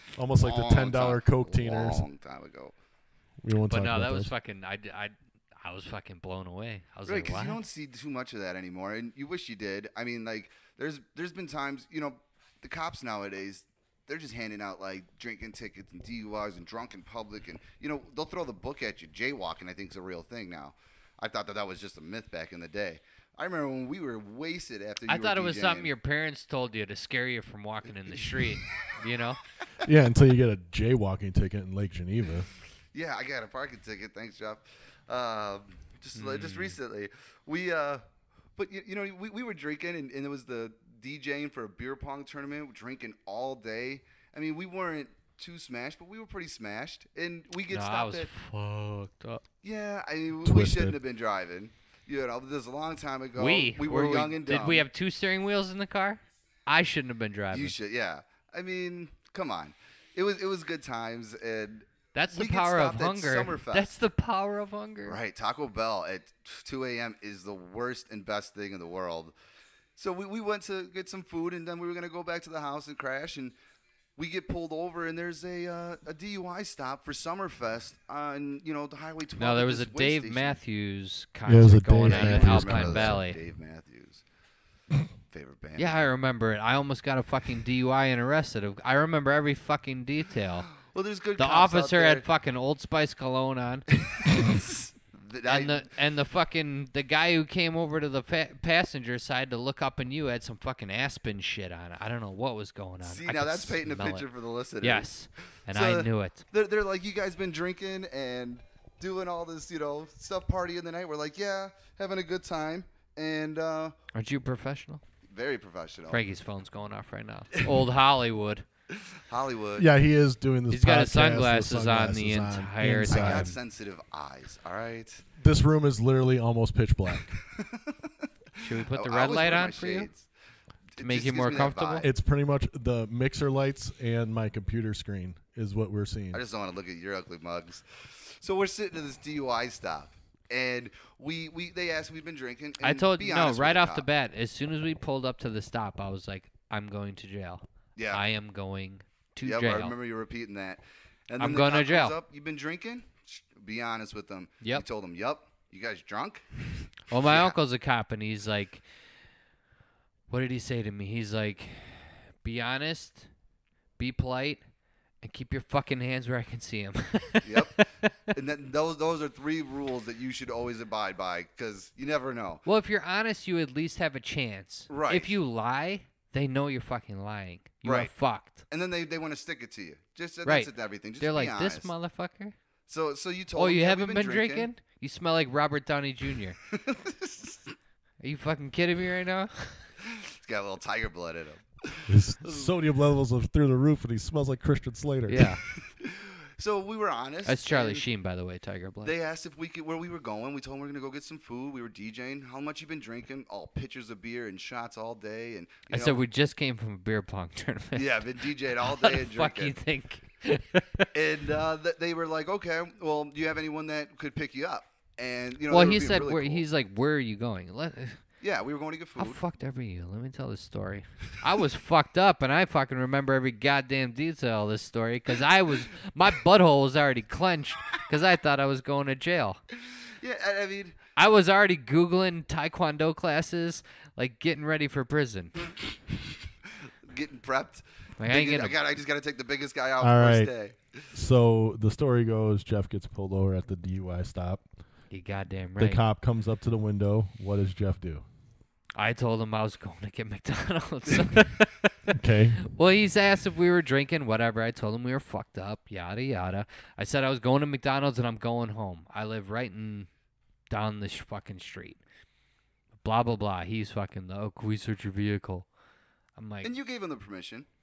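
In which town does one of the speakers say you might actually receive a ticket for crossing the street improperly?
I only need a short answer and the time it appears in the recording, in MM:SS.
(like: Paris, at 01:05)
Lake Geneva, at 00:31.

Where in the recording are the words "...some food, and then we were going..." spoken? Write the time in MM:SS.
01:11.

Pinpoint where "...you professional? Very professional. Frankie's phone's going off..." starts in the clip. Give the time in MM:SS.
01:54.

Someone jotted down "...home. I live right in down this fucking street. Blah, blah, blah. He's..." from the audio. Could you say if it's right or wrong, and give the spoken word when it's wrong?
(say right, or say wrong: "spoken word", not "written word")
right.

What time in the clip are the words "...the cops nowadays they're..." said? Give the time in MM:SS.
00:12.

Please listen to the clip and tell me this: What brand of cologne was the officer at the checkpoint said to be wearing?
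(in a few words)
Old Spice.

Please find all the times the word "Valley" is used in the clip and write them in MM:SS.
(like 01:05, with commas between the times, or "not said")
01:22.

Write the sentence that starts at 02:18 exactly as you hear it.
So we're sitting at this DUI stop, and we we they asked we've been drinking.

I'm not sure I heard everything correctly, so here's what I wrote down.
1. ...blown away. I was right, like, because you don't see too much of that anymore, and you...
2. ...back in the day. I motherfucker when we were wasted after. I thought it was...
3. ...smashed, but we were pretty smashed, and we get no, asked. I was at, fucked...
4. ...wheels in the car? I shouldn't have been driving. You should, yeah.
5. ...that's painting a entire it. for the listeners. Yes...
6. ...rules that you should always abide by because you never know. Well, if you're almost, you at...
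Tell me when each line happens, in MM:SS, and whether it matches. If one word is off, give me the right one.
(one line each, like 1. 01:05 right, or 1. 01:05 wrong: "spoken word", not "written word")
1. 00:06 right
2. 00:22 wrong: "remember", not "motherfucker"
3. 00:45 wrong: "stopped", not "asked"
4. 00:55 right
5. 01:43 wrong: "picture", not "entire"
6. 02:49 wrong: "honest", not "almost".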